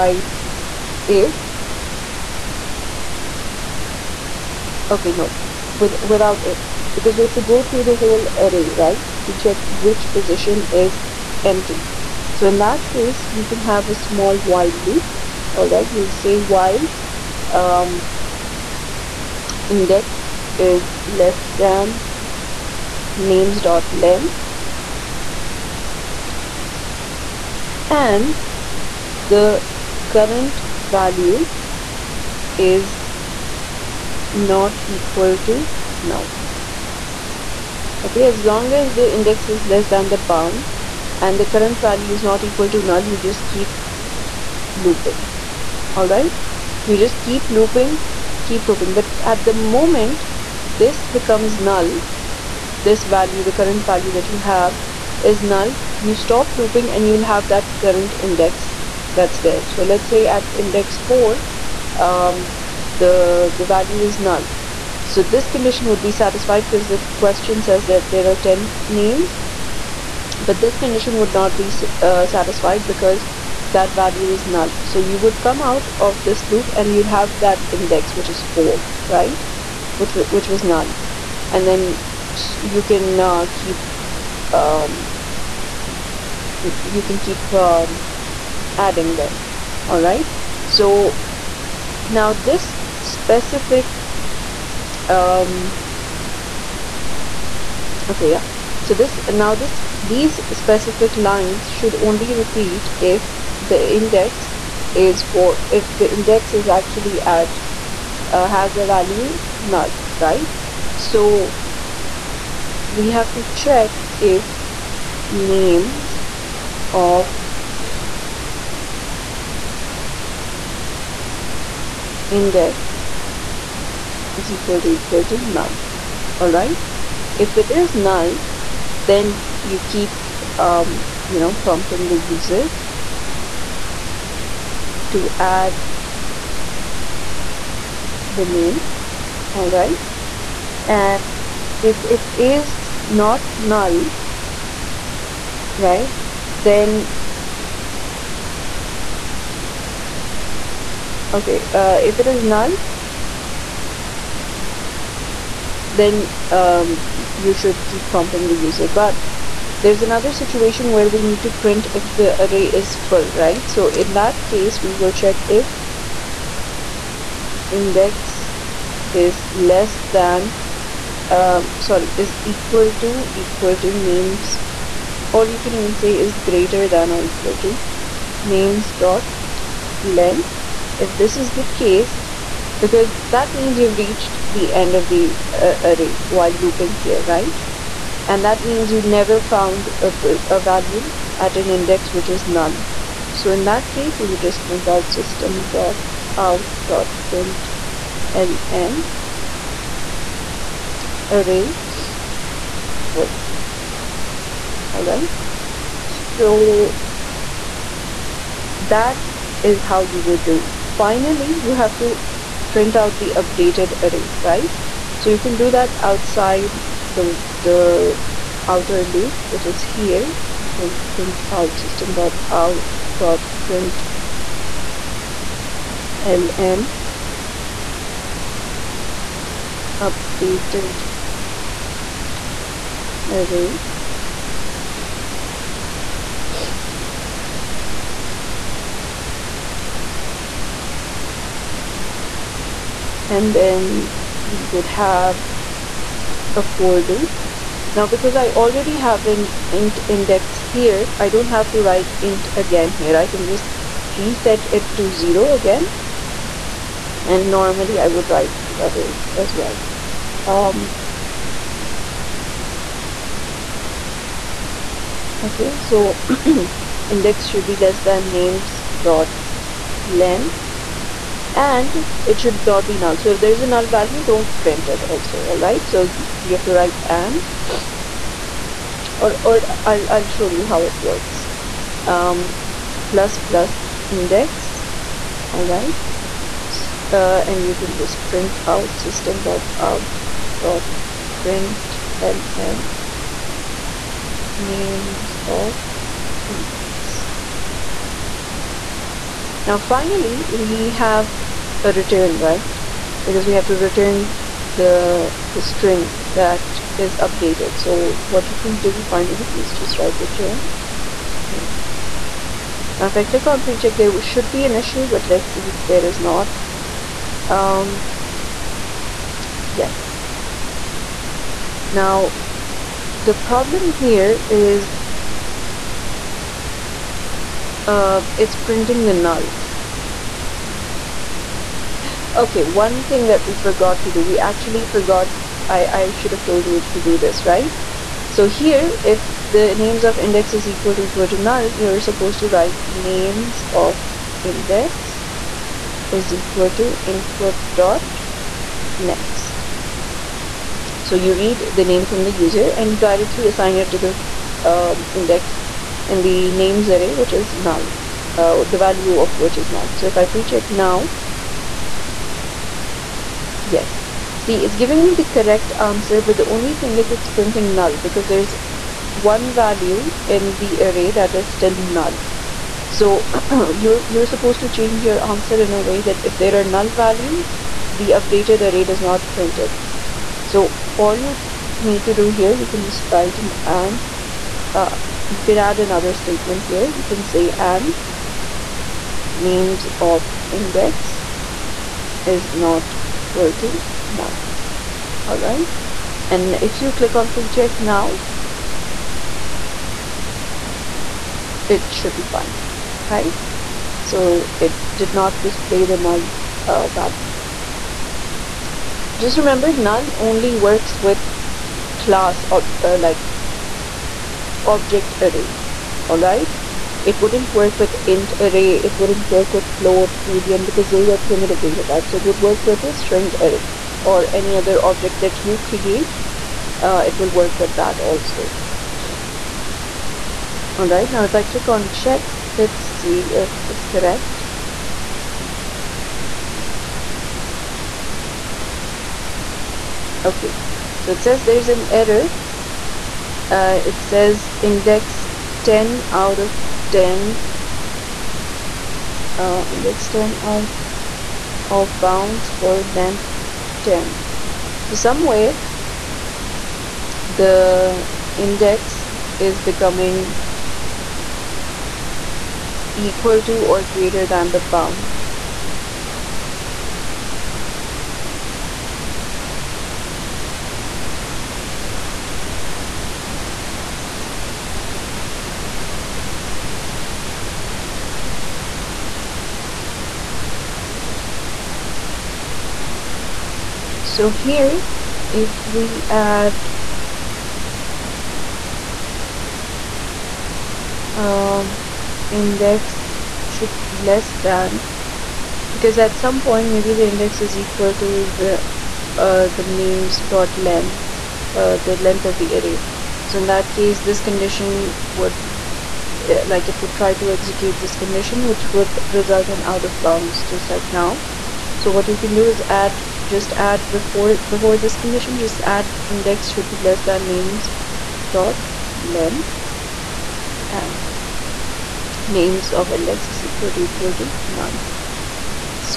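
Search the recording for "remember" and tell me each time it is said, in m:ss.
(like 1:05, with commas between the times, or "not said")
6:49.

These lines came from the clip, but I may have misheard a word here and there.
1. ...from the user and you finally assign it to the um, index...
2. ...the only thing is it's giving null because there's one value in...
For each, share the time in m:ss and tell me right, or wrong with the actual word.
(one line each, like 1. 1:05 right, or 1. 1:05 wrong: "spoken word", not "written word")
1. 5:52 wrong: "directly", not "finally"
2. 6:06 wrong: "printing", not "giving".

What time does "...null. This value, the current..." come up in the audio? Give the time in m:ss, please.
0:51.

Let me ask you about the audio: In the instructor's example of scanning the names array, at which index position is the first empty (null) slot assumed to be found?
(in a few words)
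4.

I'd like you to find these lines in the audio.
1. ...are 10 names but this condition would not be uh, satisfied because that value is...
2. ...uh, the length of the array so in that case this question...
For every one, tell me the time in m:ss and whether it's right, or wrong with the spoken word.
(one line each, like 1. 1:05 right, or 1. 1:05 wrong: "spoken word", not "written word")
1. 1:08 right
2. 8:21 wrong: "condition", not "question".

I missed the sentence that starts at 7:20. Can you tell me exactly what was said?
Okay, so it says there's an error.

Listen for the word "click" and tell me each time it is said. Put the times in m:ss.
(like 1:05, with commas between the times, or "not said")
5:13, 6:36, 7:11.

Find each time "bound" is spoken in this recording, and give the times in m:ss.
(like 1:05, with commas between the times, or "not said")
0:40, 7:31, 7:44, 8:29.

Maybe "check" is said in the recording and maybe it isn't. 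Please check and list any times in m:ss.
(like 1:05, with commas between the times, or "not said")
0:09, 1:53, 2:45, 5:13, 6:00, 6:37, 7:11.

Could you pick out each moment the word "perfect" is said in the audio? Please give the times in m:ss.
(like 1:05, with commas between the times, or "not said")
not said.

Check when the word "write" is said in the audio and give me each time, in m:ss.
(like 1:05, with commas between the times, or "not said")
4:11, 4:18, 4:36, 5:09, 5:42, 6:23.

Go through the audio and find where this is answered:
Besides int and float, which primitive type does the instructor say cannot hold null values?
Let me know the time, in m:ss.
7:00.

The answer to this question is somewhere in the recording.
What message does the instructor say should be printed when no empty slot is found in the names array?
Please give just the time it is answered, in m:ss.
3:21.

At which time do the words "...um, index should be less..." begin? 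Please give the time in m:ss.
8:11.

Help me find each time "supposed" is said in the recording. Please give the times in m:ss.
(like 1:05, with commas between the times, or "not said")
5:41, 6:14.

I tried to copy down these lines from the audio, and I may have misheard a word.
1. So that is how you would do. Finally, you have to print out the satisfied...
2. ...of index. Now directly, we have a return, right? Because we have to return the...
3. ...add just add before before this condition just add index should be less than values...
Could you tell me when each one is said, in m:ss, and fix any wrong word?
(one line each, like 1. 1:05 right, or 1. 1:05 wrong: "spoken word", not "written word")
1. 3:26 wrong: "updated", not "satisfied"
2. 4:55 wrong: "finally", not "directly"
3. 8:32 wrong: "names", not "values".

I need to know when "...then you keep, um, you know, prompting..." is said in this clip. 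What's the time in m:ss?
2:08.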